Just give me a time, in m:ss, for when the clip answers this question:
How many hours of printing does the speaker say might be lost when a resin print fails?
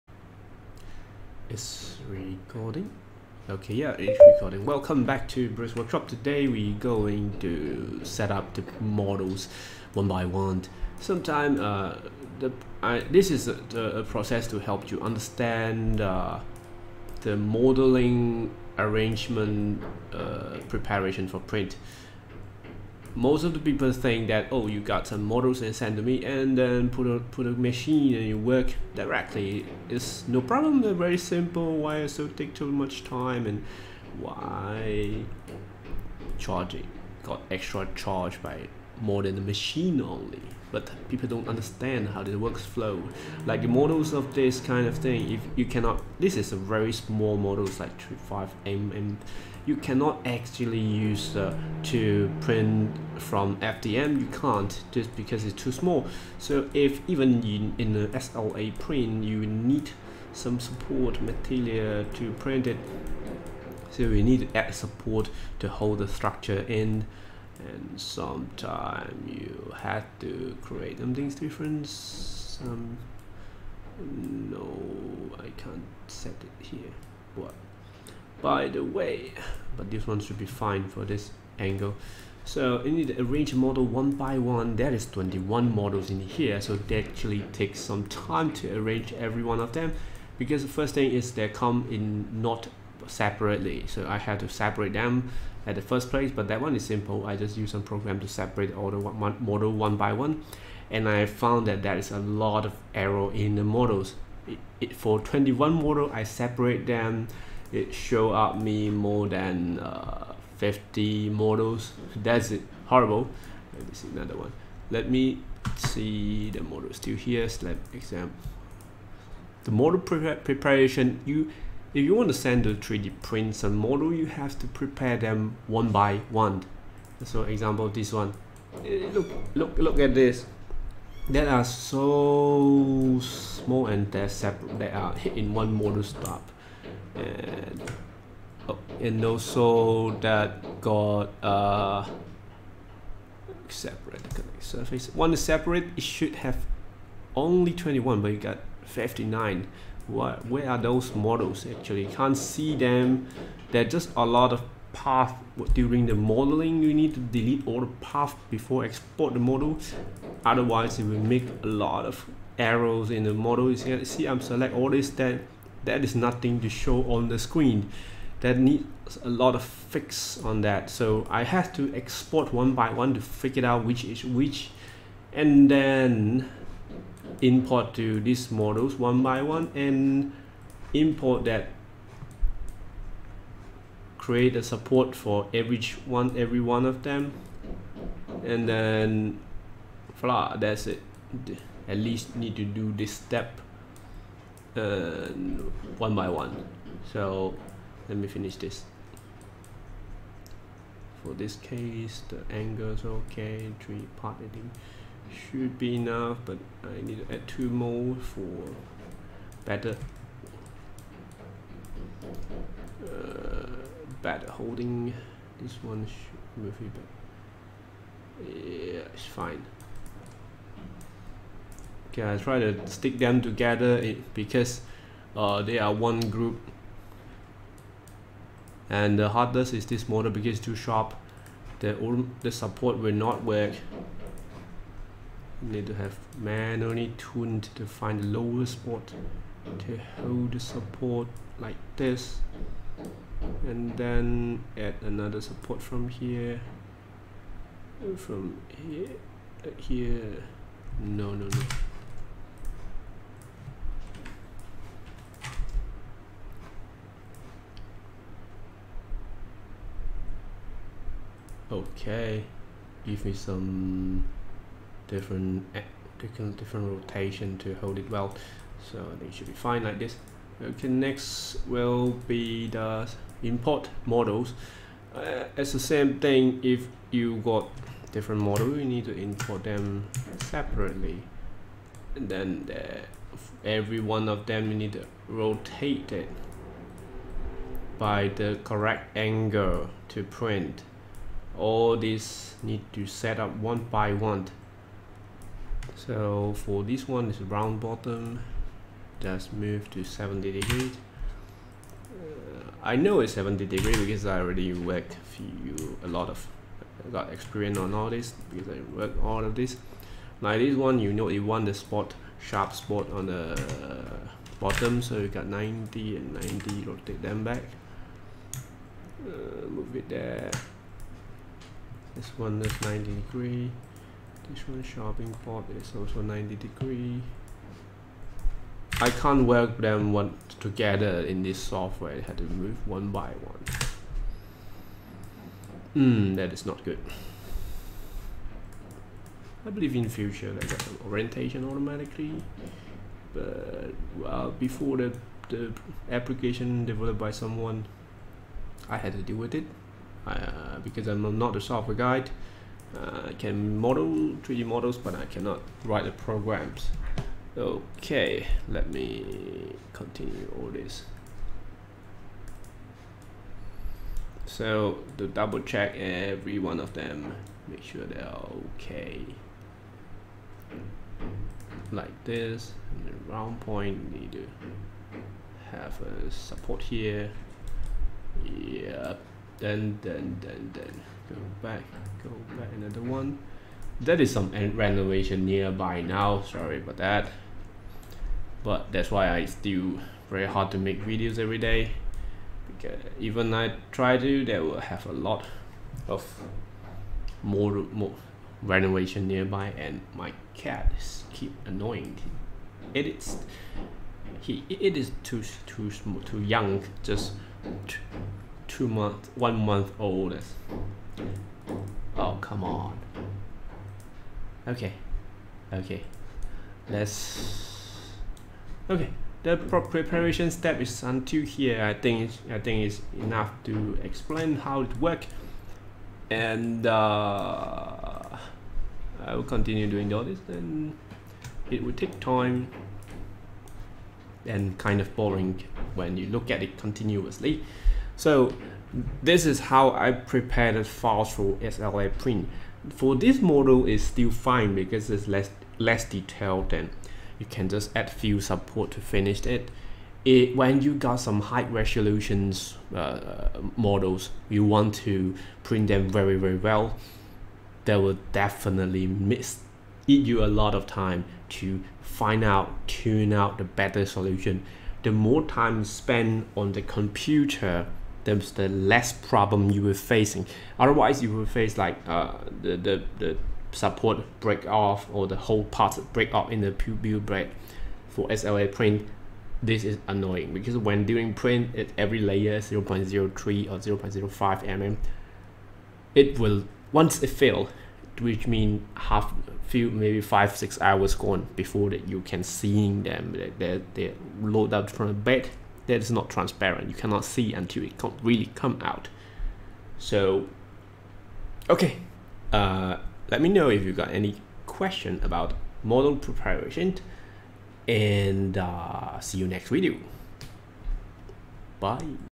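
8:10.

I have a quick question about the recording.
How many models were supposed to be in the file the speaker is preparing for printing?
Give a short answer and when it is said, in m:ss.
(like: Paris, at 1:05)
21, at 1:25.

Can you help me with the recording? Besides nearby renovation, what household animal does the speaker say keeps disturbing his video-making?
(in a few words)
cat.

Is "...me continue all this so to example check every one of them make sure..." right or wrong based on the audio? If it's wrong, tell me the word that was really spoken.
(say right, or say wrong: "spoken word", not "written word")
wrong: "double", not "example".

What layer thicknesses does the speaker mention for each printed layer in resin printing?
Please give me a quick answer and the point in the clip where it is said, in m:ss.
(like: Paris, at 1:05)
0.03 or 0.05 mm, at 8:02.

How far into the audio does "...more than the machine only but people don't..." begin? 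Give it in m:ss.
0:39.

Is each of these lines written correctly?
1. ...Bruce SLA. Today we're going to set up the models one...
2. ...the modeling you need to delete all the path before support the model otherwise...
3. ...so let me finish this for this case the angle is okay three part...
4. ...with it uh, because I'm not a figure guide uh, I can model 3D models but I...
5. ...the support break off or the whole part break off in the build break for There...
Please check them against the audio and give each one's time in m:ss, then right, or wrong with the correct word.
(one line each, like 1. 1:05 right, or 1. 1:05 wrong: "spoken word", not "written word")
1. 0:05 wrong: "Workshop", not "SLA"
2. 2:36 wrong: "export", not "support"
3. 3:17 right
4. 5:49 wrong: "software", not "figure"
5. 7:53 wrong: "SLA", not "There".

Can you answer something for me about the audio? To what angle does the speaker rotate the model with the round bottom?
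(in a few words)
70 degrees.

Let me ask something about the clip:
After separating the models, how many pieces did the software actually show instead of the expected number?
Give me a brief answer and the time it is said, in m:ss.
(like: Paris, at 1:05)
59, at 2:28.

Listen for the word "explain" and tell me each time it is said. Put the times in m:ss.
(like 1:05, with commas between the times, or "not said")
7:04.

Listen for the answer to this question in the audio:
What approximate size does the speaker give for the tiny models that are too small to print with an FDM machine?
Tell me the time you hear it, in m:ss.
0:47.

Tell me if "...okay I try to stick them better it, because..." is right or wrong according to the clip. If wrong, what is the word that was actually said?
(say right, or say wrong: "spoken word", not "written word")
wrong: "together", not "better".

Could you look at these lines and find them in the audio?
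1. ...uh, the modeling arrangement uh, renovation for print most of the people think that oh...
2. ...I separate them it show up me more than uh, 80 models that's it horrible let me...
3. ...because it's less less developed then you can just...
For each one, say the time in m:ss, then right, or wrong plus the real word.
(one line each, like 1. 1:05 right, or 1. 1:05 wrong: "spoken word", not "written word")
1. 0:15 wrong: "preparation", not "renovation"
2. 1:46 wrong: "50", not "80"
3. 7:24 wrong: "detailed", not "developed".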